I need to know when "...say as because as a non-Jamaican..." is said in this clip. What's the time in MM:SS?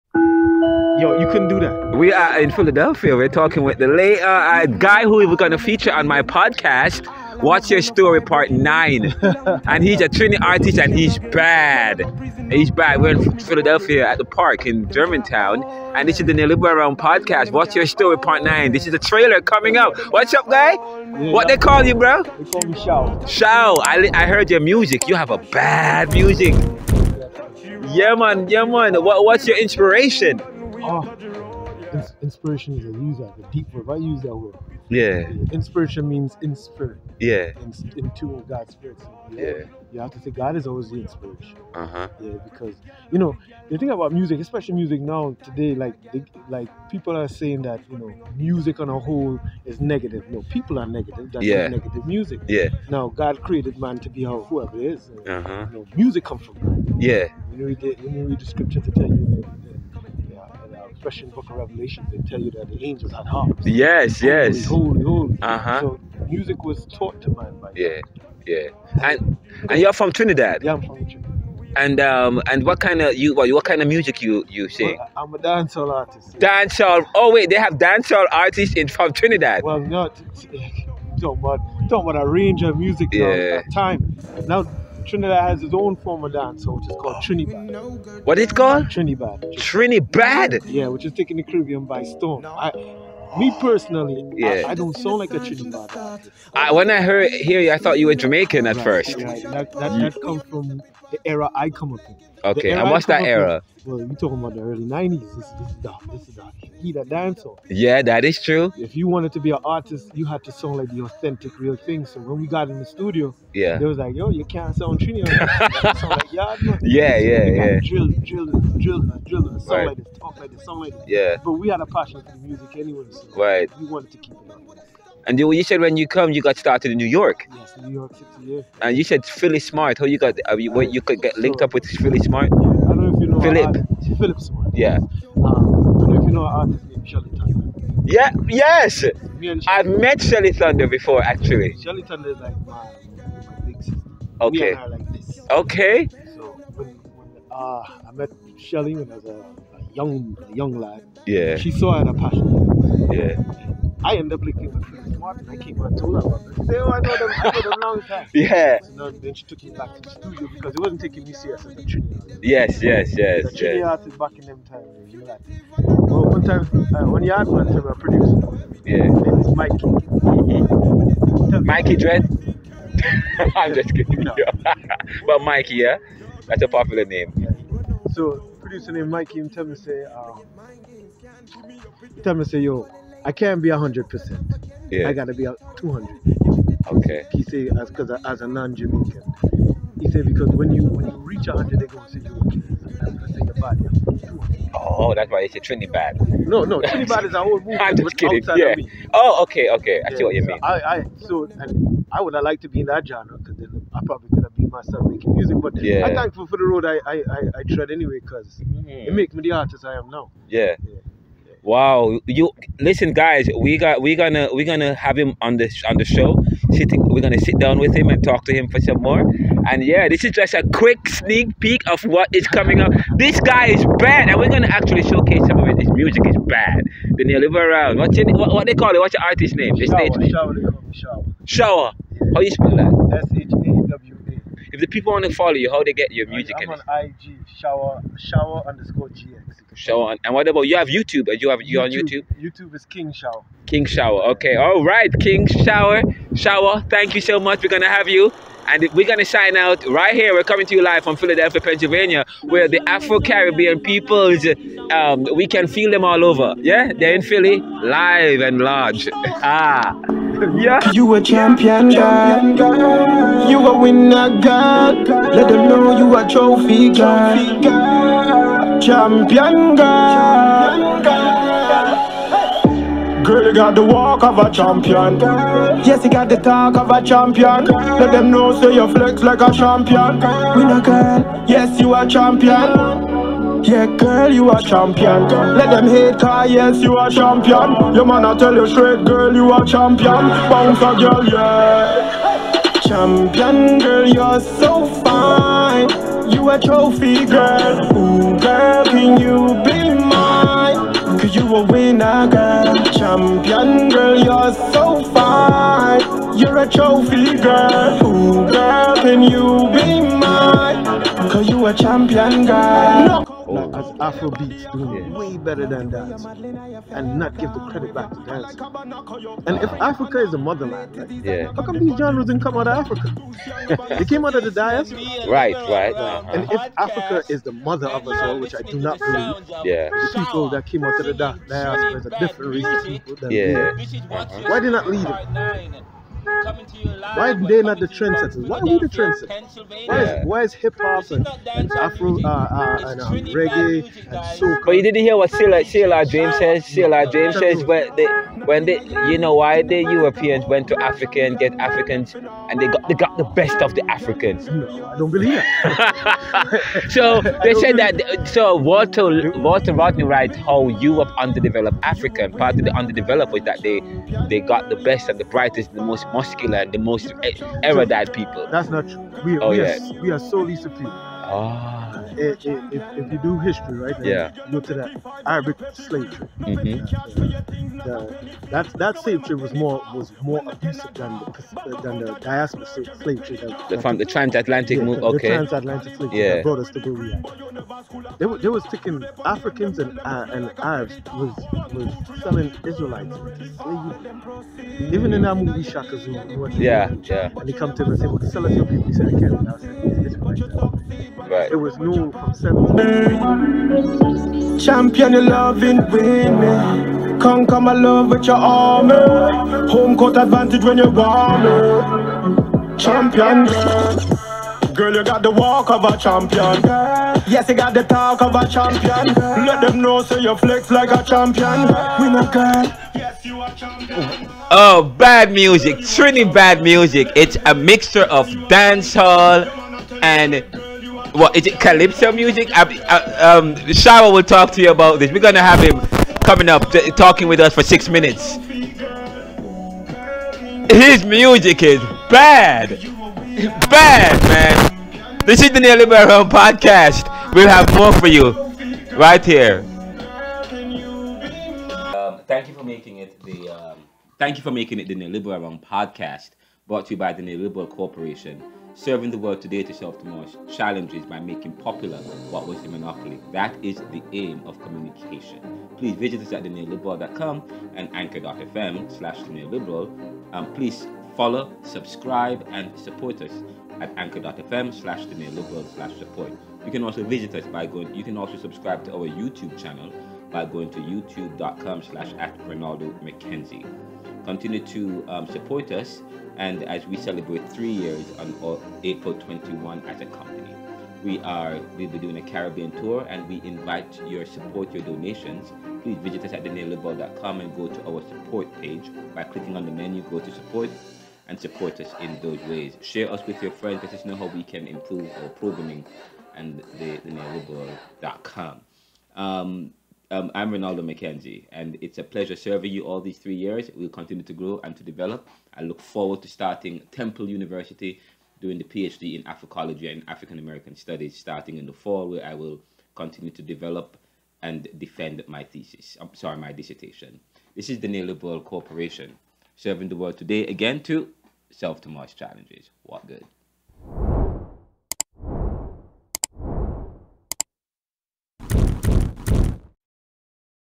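03:07.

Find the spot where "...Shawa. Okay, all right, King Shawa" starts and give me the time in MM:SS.
04:03.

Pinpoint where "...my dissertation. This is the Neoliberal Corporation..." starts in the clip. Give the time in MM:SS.
08:46.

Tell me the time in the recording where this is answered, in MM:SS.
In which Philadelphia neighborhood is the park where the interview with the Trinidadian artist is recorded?
00:14.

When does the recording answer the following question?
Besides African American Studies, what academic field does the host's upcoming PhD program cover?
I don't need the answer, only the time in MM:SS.
08:39.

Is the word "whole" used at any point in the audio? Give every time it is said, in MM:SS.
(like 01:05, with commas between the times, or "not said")
00:48, 03:17.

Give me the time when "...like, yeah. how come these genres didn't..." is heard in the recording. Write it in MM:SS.
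05:20.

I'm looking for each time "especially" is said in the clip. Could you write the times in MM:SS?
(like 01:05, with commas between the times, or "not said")
00:44, 01:01.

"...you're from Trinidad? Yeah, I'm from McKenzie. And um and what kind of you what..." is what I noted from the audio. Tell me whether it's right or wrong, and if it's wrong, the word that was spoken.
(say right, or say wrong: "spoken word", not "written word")
wrong: "Trinidad", not "McKenzie".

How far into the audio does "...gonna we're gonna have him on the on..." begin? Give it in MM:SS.
03:34.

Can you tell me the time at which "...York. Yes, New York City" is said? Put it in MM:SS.
02:07.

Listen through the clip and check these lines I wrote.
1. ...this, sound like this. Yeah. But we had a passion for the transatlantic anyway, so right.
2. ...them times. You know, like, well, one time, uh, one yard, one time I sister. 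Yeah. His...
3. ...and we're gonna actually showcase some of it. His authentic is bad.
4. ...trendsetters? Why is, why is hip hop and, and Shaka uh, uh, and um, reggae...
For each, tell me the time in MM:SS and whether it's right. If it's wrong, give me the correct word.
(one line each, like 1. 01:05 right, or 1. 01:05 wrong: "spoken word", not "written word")
1. 02:00 wrong: "music", not "transatlantic"
2. 02:44 wrong: "producer", not "sister"
3. 03:44 wrong: "music", not "authentic"
4. 05:38 wrong: "Afro", not "Shaka".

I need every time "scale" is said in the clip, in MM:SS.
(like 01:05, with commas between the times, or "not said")
not said.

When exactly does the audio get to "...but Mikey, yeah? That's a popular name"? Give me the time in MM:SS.
02:55.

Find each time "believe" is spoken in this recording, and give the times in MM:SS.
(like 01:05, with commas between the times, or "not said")
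05:28, 05:55.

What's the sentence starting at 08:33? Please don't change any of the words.
We'll continue to grow and to develop.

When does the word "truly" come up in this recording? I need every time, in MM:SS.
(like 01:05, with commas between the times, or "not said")
07:05.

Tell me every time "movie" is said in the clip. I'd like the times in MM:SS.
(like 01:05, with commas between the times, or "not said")
06:35.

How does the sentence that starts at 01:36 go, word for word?
I, when I heard hear you, I thought you were Jamaican at right, first.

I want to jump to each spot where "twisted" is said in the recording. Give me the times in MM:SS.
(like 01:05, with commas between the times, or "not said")
not said.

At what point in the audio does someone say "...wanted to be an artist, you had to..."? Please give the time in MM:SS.
01:49.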